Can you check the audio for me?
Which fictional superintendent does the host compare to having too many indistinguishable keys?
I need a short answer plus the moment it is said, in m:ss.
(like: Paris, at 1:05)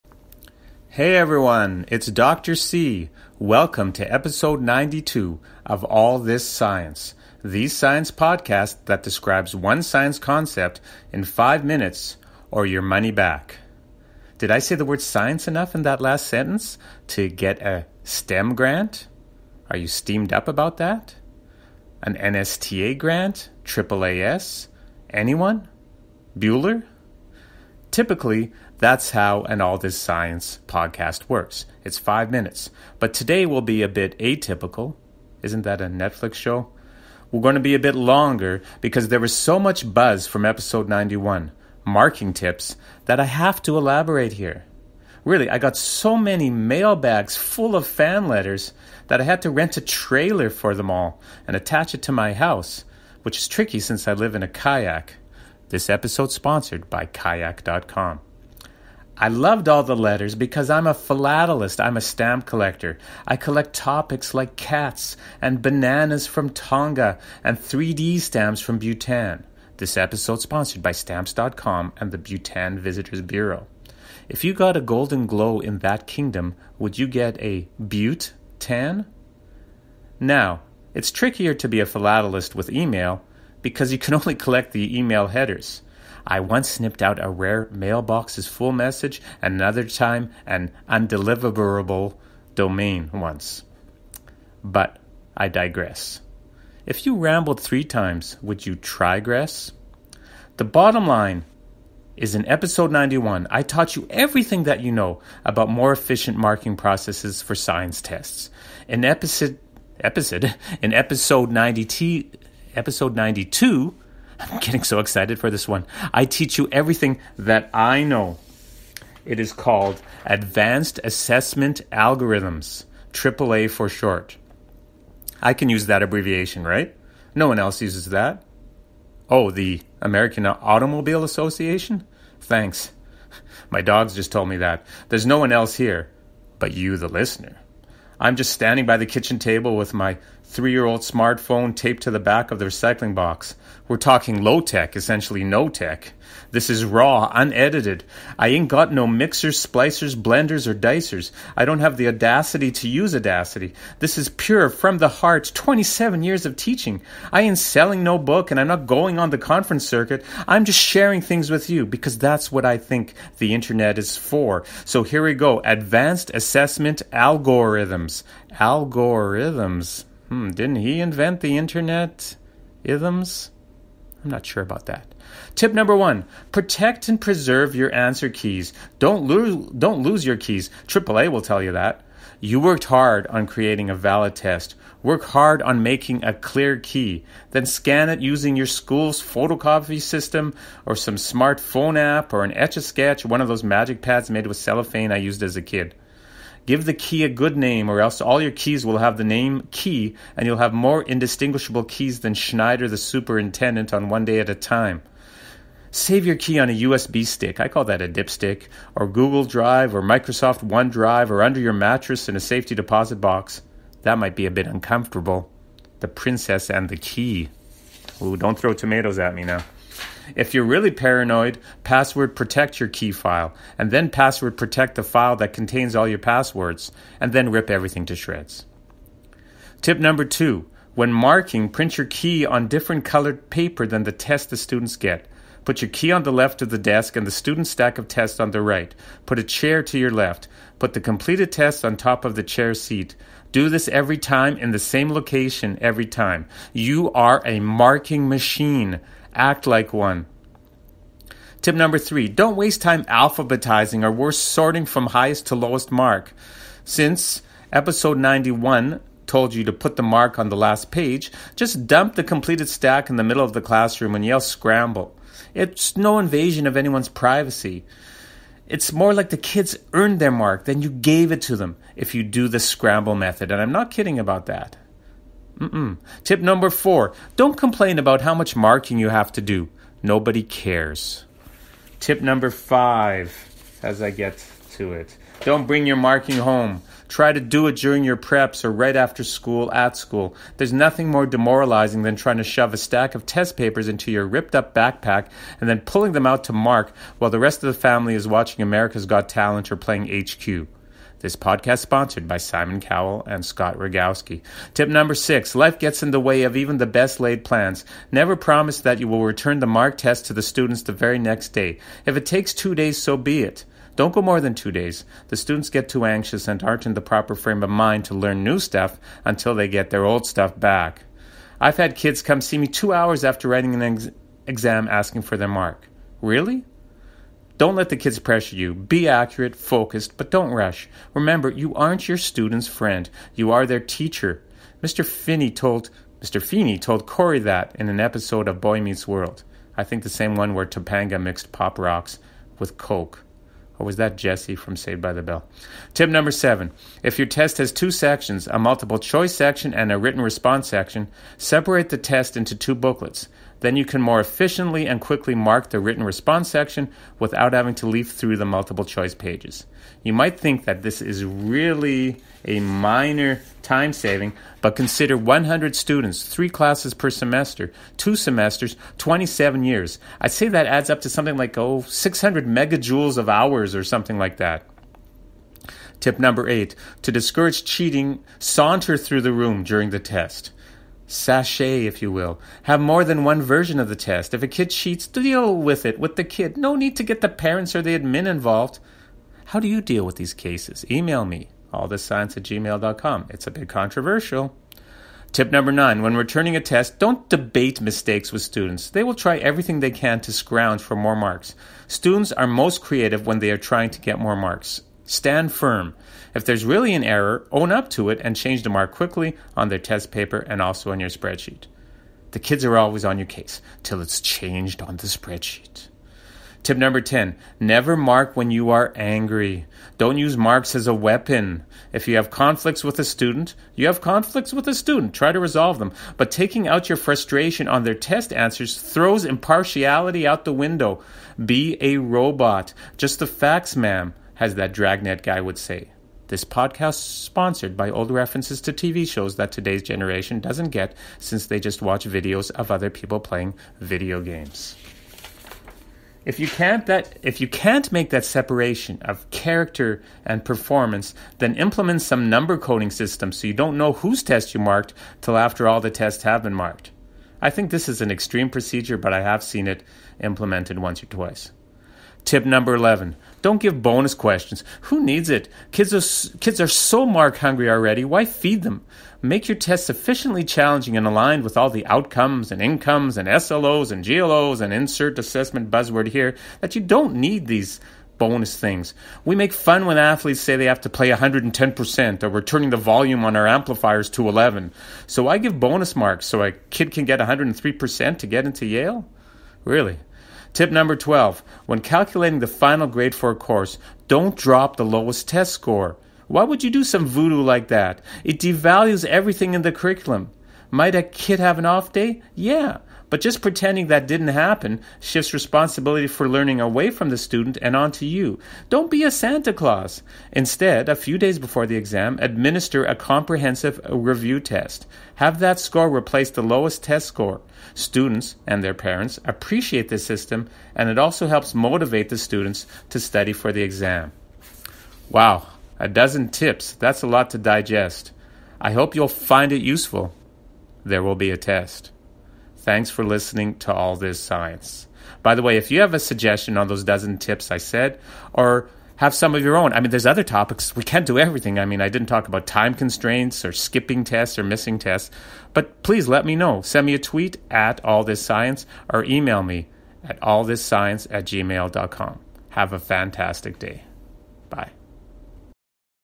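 Schneider, at 3:22.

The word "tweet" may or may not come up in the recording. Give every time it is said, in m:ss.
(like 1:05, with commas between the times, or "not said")
9:06.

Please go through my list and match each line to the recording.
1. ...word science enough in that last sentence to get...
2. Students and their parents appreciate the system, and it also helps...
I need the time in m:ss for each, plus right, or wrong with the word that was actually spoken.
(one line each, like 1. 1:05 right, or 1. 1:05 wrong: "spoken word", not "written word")
1. 0:14 right
2. 8:37 right.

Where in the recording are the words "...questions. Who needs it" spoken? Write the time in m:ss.
7:44.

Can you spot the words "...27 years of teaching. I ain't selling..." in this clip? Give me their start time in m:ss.
2:35.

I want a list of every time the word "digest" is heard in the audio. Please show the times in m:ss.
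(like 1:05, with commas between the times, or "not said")
8:47.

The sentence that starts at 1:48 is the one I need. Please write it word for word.
In episode episode in episode 90 episode 92.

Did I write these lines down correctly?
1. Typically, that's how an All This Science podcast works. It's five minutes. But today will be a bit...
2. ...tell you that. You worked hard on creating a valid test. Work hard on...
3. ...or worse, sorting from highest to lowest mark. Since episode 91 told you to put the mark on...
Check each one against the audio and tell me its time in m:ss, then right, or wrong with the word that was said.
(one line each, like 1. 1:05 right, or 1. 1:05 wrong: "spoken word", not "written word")
1. 0:27 right
2. 3:01 right
3. 4:14 right.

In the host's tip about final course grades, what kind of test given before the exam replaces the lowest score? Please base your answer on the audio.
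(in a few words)
comprehensive review test.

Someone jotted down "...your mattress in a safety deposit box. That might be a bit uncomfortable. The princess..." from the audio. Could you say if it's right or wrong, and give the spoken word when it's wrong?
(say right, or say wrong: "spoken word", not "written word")
right.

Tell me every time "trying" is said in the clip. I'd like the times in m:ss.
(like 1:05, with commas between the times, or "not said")
4:52, 6:43.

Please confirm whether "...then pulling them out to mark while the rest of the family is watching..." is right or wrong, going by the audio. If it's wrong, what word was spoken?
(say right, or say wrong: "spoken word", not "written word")
right.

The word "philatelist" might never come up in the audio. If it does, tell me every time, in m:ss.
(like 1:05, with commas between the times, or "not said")
1:00, 1:21.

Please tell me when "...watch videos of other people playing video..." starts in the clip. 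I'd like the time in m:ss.
7:21.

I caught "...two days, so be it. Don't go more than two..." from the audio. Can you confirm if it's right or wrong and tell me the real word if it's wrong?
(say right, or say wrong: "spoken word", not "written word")
right.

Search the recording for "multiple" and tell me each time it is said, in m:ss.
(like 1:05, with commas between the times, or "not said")
5:48, 5:58.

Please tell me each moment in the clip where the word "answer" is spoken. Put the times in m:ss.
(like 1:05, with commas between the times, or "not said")
2:57, 7:08.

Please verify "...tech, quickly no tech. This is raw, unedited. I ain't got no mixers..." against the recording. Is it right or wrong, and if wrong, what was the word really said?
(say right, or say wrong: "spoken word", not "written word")
wrong: "essentially", not "quickly".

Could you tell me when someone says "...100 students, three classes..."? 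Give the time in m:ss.
6:05.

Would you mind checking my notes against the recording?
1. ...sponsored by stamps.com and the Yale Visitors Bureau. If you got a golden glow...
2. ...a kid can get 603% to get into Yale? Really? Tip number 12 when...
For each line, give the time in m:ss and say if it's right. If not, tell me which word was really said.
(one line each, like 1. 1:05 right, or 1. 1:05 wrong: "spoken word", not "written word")
1. 1:10 wrong: "Bhutan", not "Yale"
2. 8:06 wrong: "103", not "603".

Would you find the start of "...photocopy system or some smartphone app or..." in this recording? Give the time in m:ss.
3:09.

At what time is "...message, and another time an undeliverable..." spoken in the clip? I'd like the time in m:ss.
1:28.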